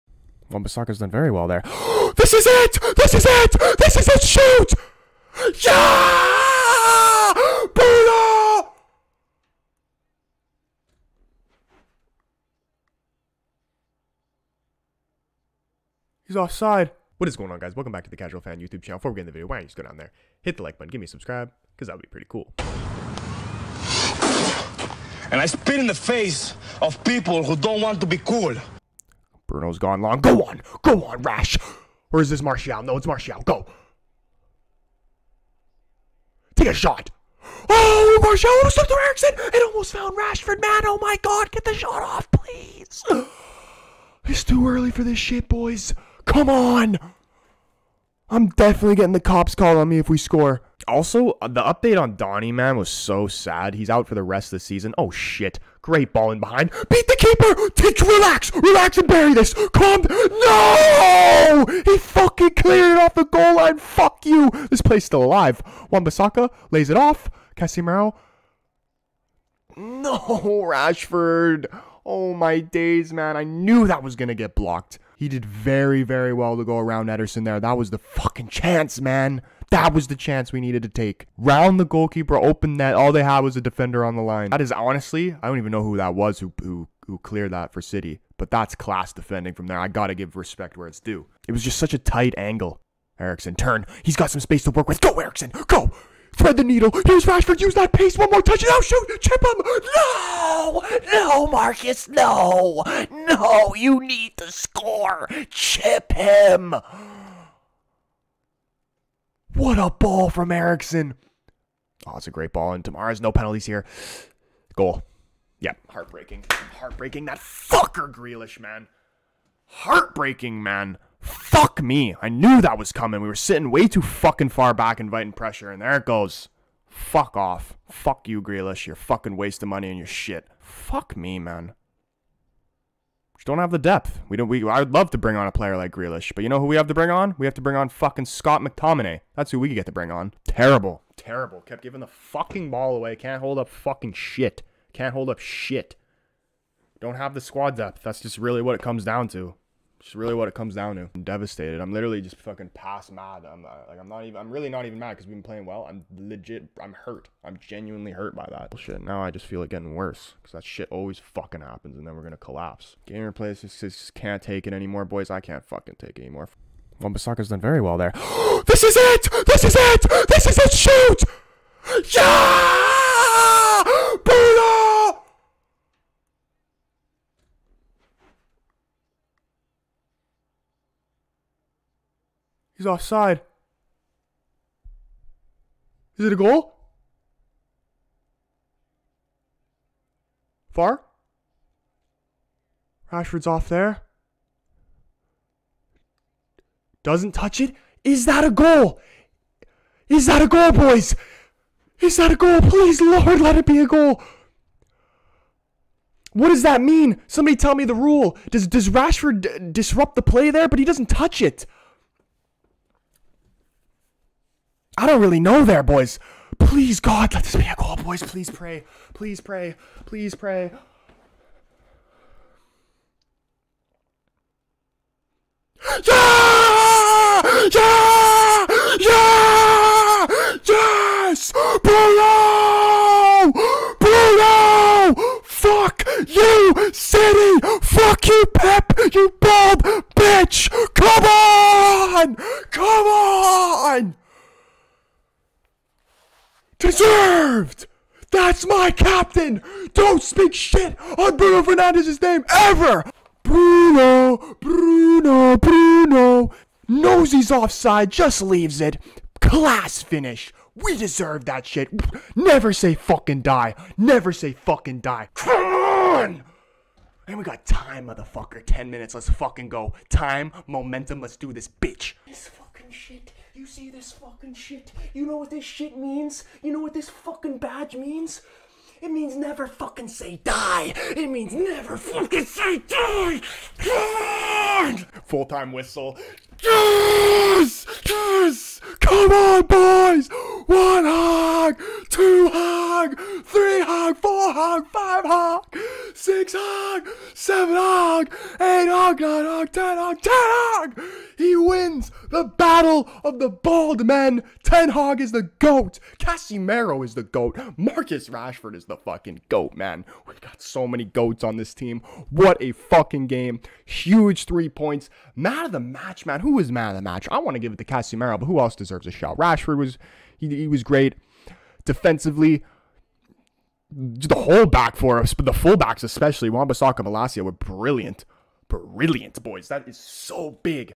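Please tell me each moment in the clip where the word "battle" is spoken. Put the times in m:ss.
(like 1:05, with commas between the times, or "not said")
5:02.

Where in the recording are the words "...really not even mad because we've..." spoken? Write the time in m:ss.
2:34.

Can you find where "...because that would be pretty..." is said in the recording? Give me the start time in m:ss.
0:21.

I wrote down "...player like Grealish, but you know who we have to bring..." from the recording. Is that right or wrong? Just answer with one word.
right.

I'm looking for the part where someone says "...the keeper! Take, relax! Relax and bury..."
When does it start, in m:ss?
0:57.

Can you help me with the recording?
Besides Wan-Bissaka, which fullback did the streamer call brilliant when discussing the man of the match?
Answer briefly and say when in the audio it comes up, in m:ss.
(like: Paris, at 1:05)
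Malacia, at 5:26.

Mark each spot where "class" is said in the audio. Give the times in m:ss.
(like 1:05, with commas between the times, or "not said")
1:28, 4:19.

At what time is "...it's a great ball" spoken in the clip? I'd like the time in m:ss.
1:52.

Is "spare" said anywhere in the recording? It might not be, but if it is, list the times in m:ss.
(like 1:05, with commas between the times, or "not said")
not said.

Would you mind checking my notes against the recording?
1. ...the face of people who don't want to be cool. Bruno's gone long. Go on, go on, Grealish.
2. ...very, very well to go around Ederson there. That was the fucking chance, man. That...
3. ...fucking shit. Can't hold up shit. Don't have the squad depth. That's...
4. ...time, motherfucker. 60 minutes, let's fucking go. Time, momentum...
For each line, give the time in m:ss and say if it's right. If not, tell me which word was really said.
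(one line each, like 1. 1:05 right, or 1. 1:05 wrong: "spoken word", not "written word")
1. 0:25 wrong: "Rash", not "Grealish"
2. 1:15 right
3. 2:23 right
4. 4:27 wrong: "10", not "60".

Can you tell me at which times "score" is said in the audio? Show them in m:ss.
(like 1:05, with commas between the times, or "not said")
0:50, 1:44.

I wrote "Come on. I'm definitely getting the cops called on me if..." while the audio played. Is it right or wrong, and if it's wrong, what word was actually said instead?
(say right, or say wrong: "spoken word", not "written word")
right.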